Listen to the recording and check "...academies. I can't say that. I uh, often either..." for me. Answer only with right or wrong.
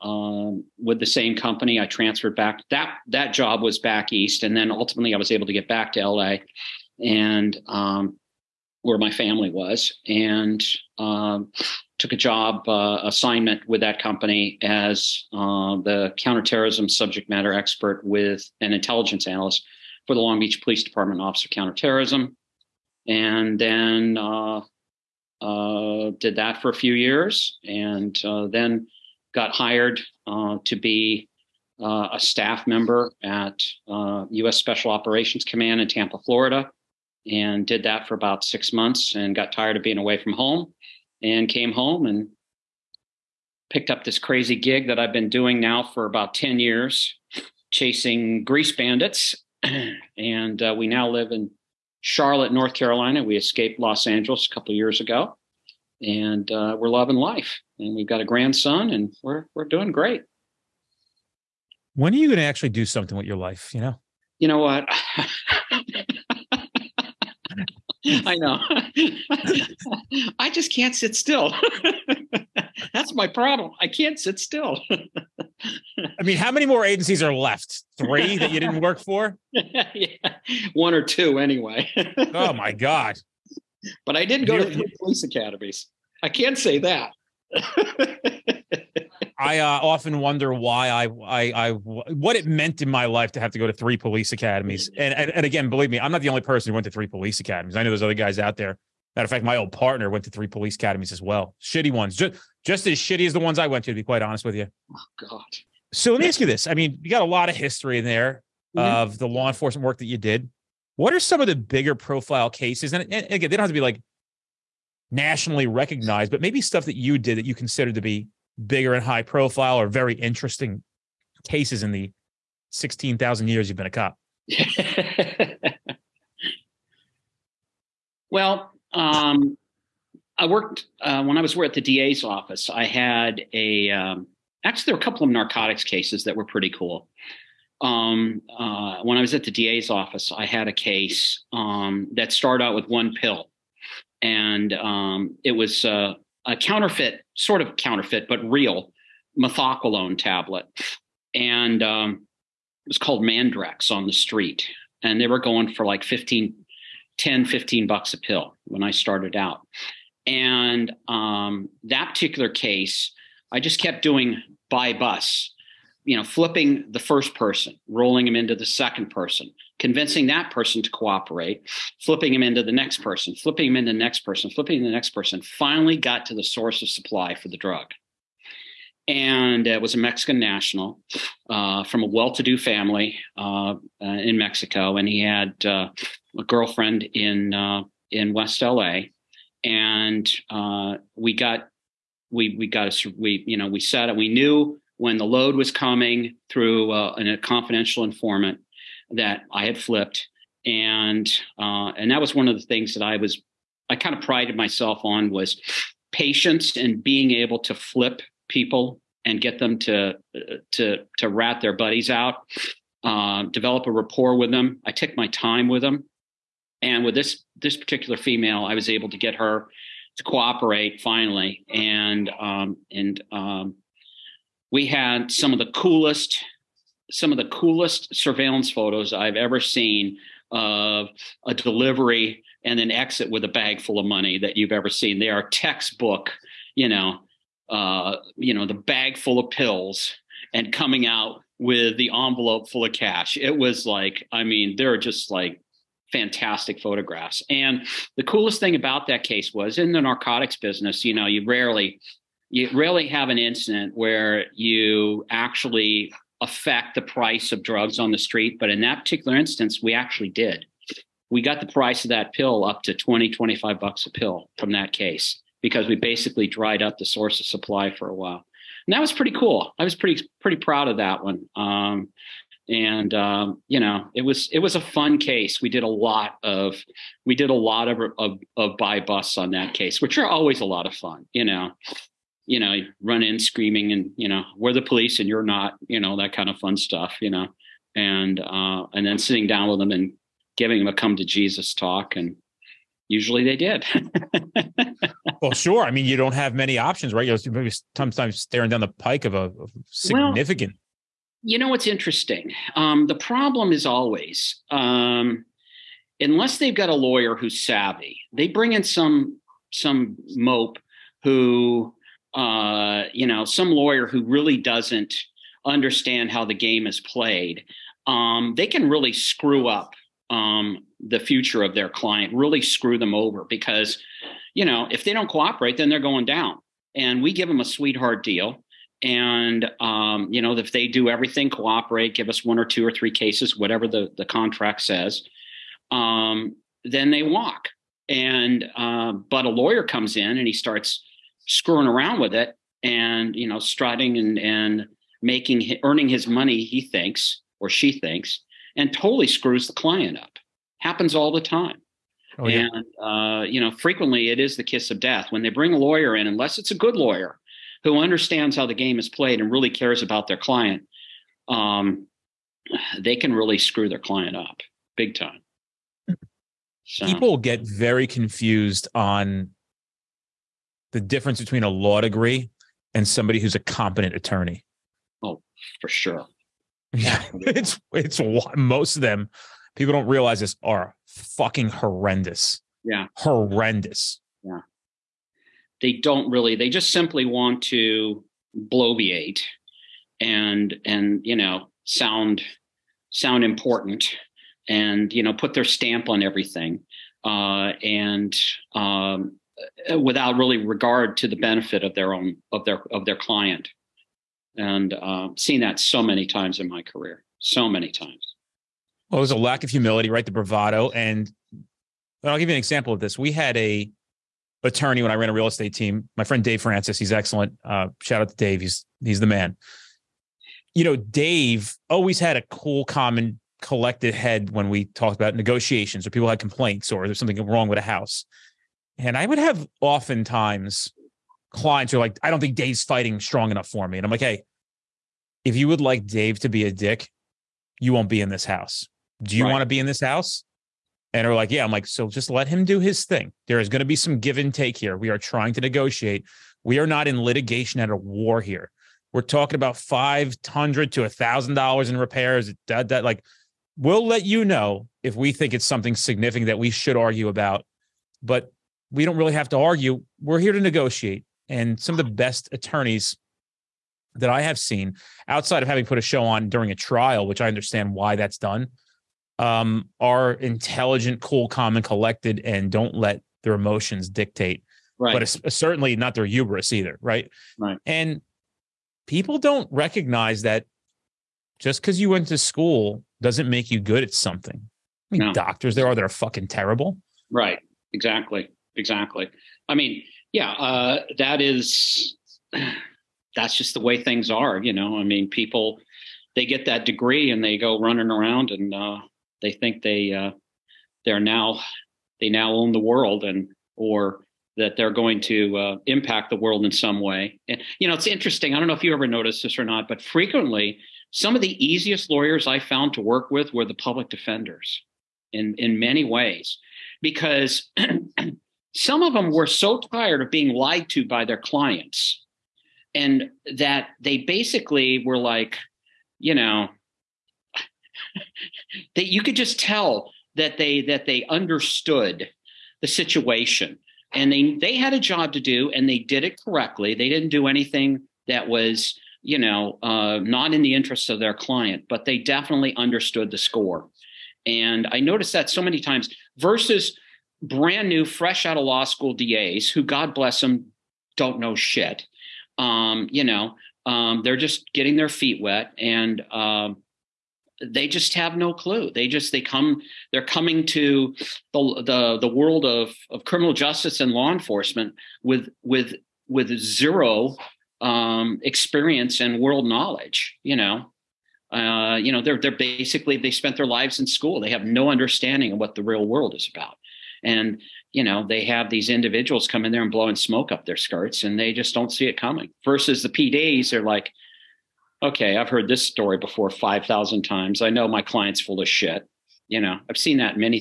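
wrong.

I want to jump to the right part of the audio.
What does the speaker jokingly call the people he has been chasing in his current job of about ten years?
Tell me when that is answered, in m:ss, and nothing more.
0:48.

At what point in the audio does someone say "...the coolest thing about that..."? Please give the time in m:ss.
4:08.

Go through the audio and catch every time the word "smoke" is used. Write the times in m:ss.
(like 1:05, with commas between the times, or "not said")
9:40.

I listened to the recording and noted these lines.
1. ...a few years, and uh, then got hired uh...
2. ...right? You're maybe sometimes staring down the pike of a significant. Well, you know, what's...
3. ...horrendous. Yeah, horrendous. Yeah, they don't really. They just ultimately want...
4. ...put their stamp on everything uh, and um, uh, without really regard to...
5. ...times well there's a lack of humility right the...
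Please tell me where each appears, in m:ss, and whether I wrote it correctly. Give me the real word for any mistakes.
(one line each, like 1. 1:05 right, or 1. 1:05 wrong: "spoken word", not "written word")
1. 0:26 right
2. 4:57 right
3. 6:21 wrong: "simply", not "ultimately"
4. 6:35 right
5. 6:47 right.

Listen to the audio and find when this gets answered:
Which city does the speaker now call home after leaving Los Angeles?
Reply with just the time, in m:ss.
0:52.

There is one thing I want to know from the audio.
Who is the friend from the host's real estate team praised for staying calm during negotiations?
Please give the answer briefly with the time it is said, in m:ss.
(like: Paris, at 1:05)
Dave Francis, at 6:56.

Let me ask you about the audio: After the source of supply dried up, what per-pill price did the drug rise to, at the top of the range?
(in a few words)
25 bucks.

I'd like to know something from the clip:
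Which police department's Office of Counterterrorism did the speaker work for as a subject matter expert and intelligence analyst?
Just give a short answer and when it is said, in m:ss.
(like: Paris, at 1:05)
Long Beach Police Department, at 0:20.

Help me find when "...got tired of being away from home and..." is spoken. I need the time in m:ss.
0:39.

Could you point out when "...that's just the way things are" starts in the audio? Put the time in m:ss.
8:13.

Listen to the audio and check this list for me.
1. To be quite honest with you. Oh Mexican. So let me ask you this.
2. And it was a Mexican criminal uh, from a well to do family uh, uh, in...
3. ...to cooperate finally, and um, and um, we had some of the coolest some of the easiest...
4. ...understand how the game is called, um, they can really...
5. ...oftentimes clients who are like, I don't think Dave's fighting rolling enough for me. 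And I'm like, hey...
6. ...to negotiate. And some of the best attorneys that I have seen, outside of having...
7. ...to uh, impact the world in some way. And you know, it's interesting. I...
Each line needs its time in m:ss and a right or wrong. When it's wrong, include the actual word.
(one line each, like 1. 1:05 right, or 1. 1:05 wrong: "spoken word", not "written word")
1. 1:43 wrong: "God", not "Mexican"
2. 2:59 wrong: "national", not "criminal"
3. 3:40 wrong: "coolest", not "easiest"
4. 5:15 wrong: "played", not "called"
5. 7:09 wrong: "strong", not "rolling"
6. 7:40 right
7. 8:25 right.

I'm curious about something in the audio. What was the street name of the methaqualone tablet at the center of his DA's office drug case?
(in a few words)
Mandrax.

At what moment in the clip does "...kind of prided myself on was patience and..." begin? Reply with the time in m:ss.
3:23.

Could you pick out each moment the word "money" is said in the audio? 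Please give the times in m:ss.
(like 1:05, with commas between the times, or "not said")
3:54, 5:46.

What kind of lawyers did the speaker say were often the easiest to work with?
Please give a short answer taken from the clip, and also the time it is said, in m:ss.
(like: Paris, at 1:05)
public defenders, at 8:33.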